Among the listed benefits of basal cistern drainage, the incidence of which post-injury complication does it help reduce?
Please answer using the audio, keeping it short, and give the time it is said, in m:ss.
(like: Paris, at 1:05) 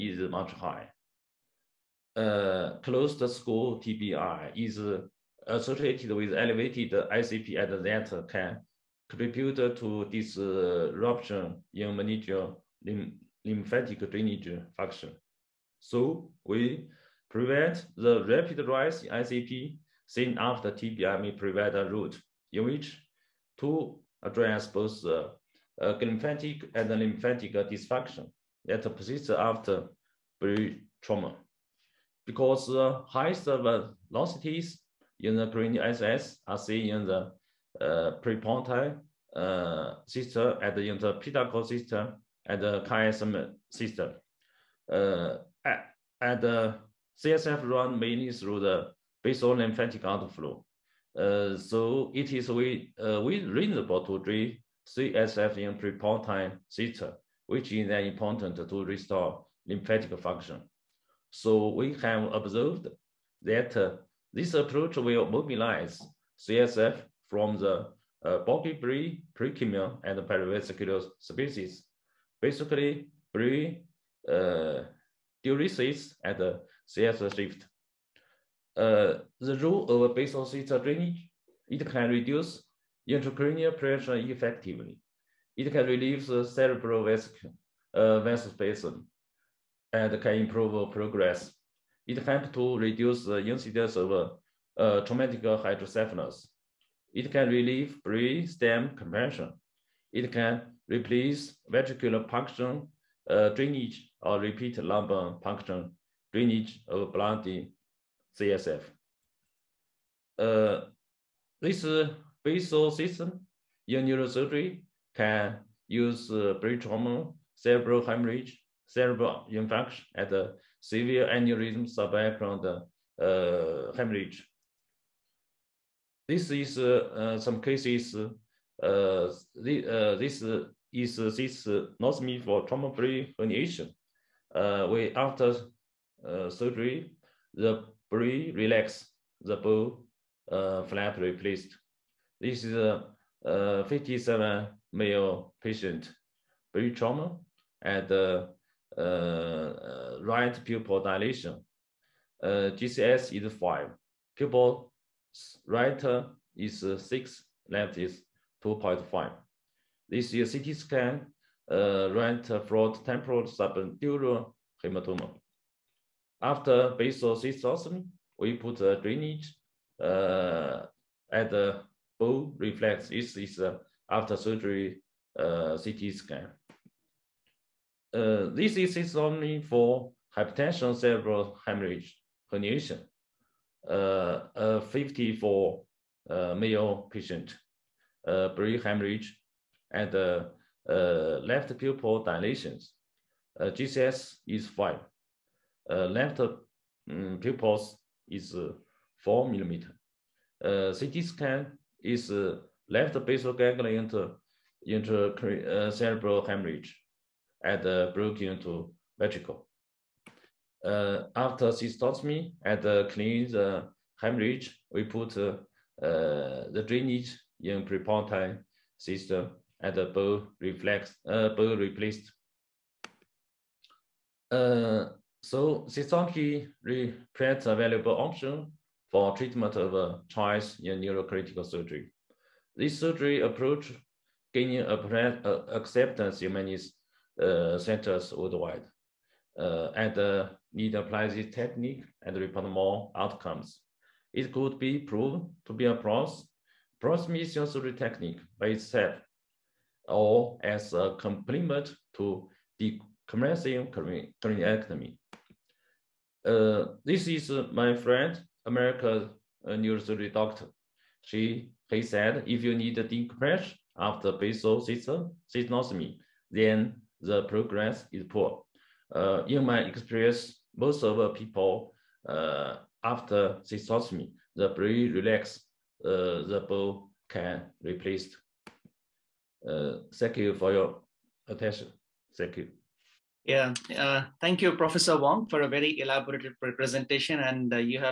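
Traumatic hydrocephalus, at 1:35.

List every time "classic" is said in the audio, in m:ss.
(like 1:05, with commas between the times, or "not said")
not said.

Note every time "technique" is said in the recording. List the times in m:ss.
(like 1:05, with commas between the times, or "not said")
4:01, 4:07.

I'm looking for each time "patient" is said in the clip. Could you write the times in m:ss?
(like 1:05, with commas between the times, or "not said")
2:25, 3:07.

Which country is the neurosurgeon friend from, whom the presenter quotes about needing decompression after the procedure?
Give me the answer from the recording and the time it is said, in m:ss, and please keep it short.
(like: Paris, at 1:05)
America, at 4:18.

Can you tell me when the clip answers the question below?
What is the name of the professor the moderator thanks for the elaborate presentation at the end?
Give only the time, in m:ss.
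4:44.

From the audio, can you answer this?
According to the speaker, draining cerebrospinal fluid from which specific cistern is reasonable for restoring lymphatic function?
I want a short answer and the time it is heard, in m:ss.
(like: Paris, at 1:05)
Prepontine cistern, at 0:55.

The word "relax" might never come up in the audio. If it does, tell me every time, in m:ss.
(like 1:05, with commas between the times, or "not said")
2:18, 4:35.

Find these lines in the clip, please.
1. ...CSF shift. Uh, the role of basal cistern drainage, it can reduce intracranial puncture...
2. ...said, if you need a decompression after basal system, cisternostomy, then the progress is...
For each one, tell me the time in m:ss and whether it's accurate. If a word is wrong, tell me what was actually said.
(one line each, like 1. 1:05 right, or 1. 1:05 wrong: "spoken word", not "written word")
1. 1:16 wrong: "pressure", not "puncture"
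2. 4:22 wrong: "synostomy", not "cisternostomy".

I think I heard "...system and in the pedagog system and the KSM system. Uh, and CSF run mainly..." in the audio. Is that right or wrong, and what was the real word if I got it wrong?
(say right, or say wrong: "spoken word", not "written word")
right.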